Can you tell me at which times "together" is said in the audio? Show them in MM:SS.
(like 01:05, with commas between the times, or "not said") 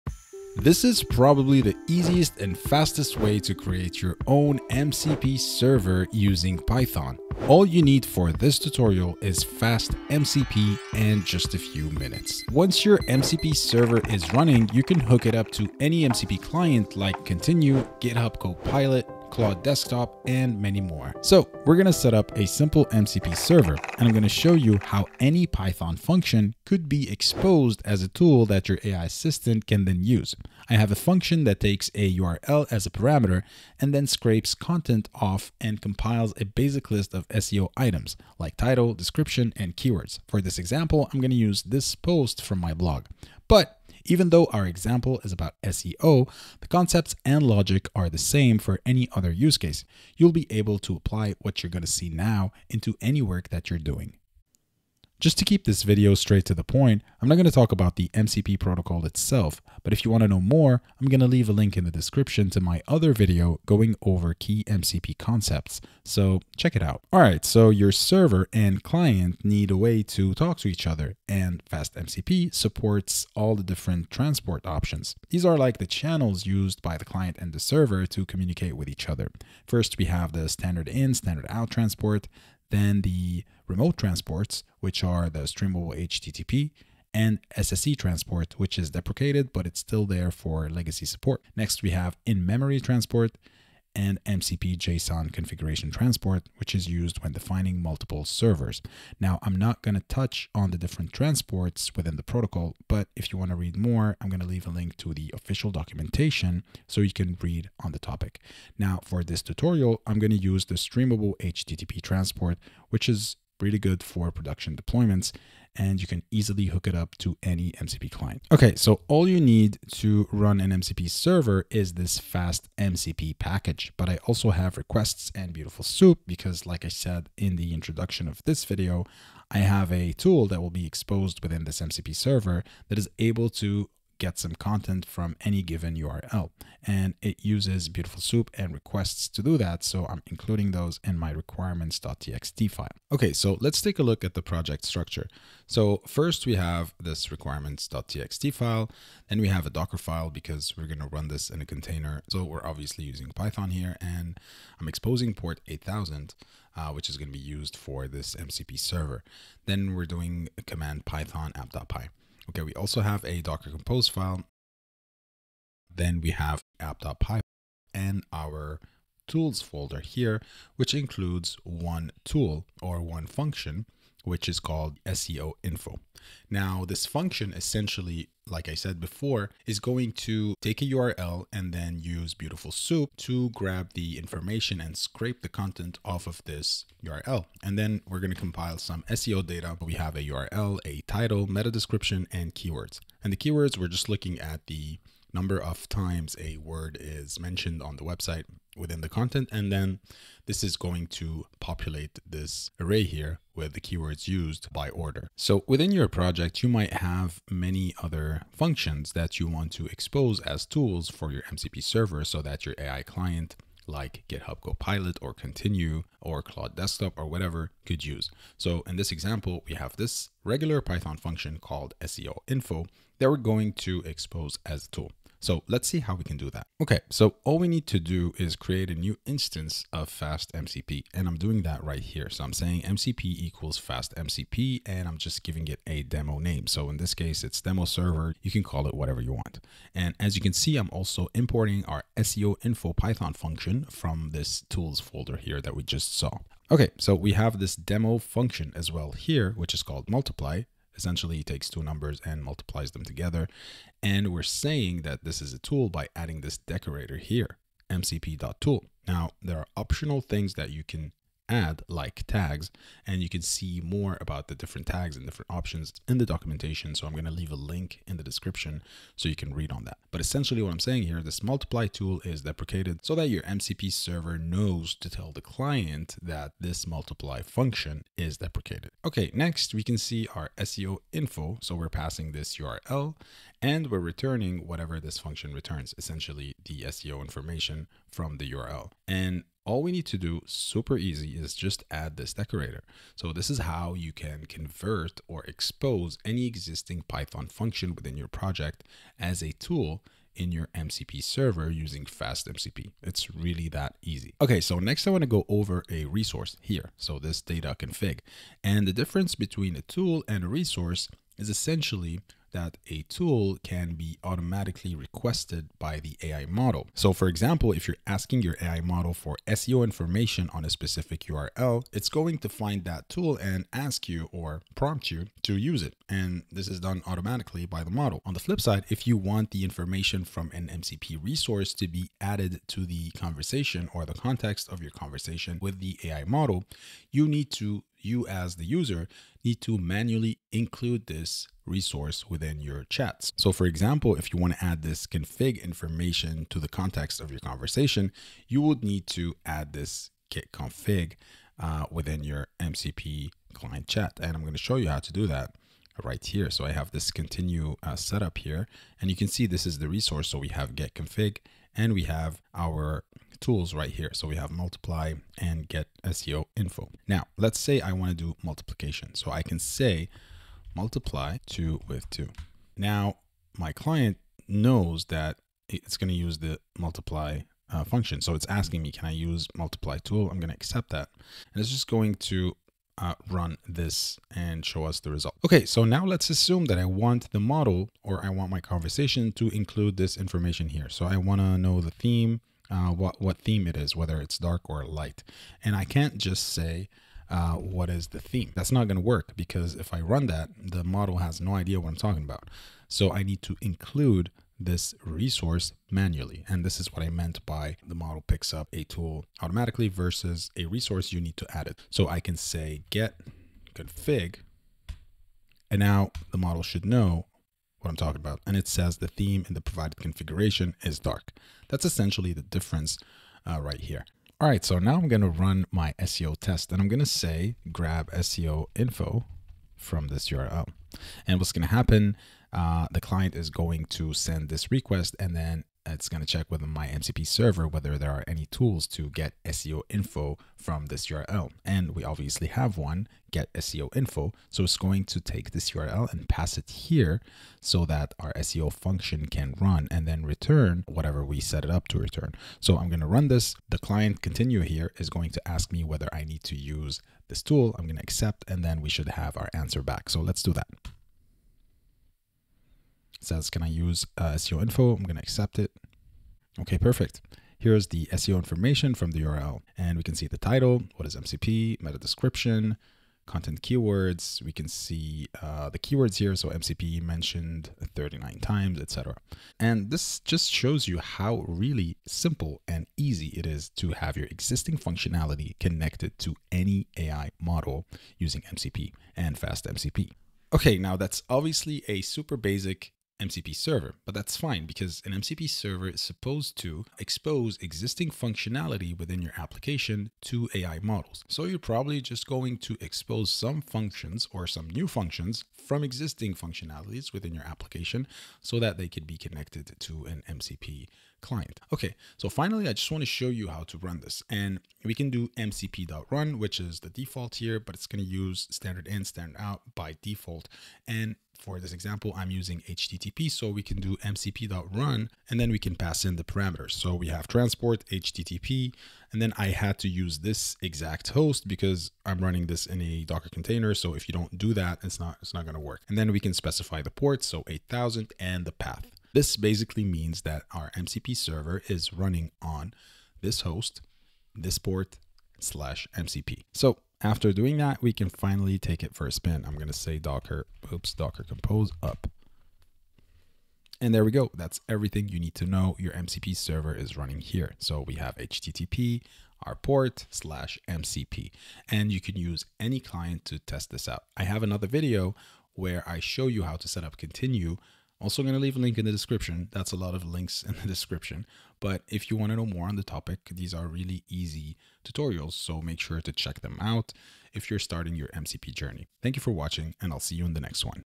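04:13.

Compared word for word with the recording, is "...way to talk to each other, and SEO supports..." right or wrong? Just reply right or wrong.
wrong.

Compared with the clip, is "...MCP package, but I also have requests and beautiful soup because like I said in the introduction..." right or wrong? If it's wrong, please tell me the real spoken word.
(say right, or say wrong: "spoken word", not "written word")
right.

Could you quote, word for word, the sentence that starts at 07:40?
So let's do that says, can I use uh, SEO info?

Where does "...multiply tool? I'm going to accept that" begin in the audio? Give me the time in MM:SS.
06:19.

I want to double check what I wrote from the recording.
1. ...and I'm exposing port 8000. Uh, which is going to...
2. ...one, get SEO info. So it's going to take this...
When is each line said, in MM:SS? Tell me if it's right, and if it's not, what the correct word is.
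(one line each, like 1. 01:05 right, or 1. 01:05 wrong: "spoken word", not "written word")
1. 02:33 right
2. 07:22 right.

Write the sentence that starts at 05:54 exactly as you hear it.
And I'm going to show you how to do that right here.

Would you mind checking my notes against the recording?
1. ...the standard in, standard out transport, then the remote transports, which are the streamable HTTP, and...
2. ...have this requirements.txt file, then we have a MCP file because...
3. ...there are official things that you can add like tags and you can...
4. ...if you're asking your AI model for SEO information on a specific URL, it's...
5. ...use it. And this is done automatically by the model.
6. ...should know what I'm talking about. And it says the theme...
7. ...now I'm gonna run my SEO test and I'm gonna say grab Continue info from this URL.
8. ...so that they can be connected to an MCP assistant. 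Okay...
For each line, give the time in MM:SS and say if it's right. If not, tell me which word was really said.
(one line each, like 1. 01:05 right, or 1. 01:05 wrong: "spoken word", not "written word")
1. 01:20 right
2. 02:26 wrong: "Docker", not "MCP"
3. 04:19 wrong: "optional", not "official"
4. 05:17 right
5. 05:25 right
6. 06:56 right
7. 07:04 wrong: "SEO", not "Continue"
8. 08:28 wrong: "client", not "assistant".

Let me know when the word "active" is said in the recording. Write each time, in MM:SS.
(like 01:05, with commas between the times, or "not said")
not said.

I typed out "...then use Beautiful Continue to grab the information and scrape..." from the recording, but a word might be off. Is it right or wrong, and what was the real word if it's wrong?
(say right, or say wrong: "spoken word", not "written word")
wrong: "Soup", not "Continue".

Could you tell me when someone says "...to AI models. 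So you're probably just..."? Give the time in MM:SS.
08:20.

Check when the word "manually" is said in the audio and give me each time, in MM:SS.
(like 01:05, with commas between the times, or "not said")
05:39, 06:45.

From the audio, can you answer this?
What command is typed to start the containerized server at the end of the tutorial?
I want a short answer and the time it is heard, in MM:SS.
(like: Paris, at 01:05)
docker compose up, at 09:10.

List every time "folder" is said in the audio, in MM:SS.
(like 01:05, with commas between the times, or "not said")
02:49, 04:04.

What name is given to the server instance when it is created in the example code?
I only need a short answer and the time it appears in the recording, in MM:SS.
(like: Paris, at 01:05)
demo server, at 03:57.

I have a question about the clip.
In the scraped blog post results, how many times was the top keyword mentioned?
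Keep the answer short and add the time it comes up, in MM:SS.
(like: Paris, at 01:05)
39, at 07:57.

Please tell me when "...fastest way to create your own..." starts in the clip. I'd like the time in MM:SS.
00:02.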